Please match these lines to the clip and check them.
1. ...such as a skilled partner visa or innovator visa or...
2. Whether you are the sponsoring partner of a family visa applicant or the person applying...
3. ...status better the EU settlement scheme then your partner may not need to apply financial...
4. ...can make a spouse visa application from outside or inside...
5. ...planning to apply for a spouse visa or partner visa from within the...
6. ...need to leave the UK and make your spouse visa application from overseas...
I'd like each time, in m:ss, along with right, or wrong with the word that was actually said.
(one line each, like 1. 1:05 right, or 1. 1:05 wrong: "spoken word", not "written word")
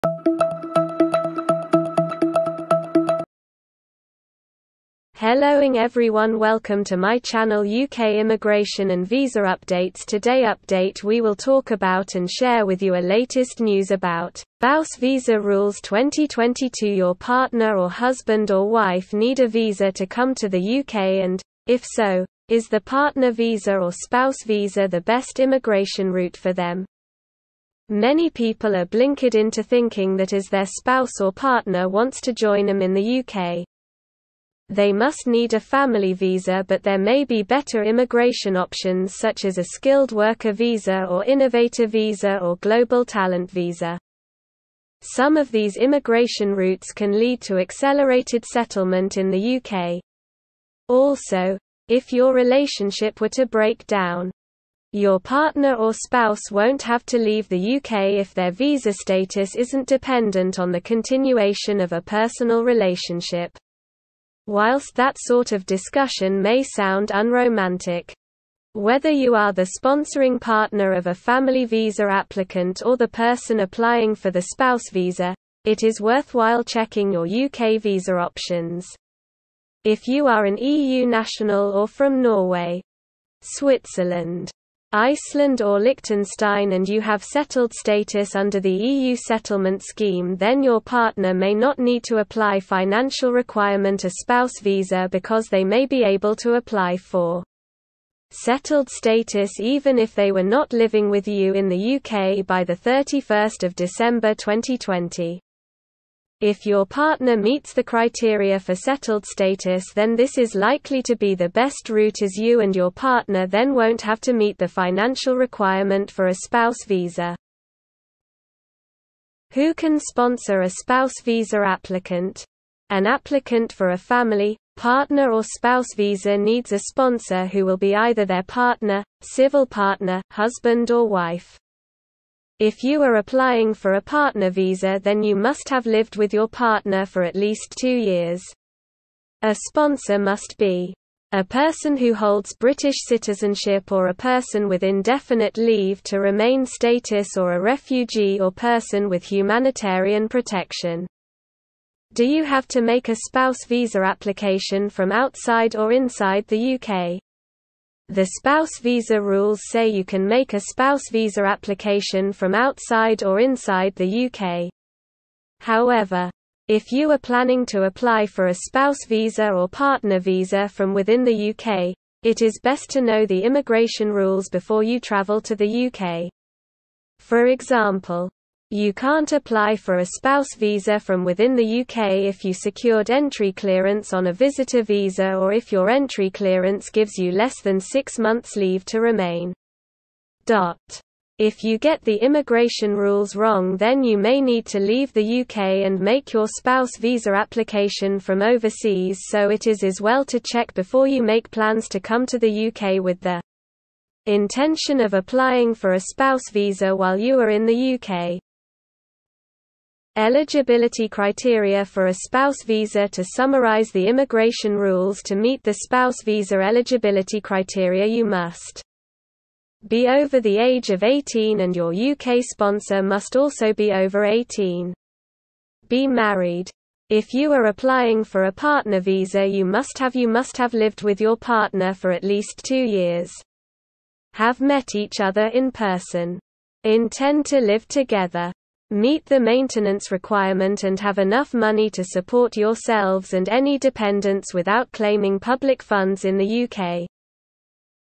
1. 0:39 wrong: "worker", not "partner"
2. 1:08 right
3. 1:27 wrong: "under", not "better"
4. 2:40 right
5. 2:47 right
6. 3:14 right.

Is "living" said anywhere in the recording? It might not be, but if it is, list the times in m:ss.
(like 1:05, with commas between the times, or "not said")
1:40.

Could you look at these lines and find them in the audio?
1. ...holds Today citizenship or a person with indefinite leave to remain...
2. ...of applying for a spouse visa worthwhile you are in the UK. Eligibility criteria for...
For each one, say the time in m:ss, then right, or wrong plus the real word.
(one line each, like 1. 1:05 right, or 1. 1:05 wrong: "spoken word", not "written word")
1. 2:22 wrong: "British", not "Today"
2. 3:25 wrong: "while", not "worthwhile".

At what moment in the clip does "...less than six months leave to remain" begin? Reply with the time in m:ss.
3:07.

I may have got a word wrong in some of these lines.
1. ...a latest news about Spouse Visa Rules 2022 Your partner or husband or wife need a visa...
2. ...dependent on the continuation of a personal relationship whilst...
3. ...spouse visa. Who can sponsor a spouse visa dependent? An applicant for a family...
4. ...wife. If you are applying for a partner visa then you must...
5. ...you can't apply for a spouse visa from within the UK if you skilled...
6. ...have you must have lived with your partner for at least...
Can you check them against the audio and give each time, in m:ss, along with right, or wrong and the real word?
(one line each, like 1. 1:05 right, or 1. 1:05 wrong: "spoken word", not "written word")
1. 0:12 right
2. 0:59 right
3. 1:56 wrong: "applicant", not "dependent"
4. 2:11 right
5. 2:58 wrong: "secured", not "skilled"
6. 3:49 right.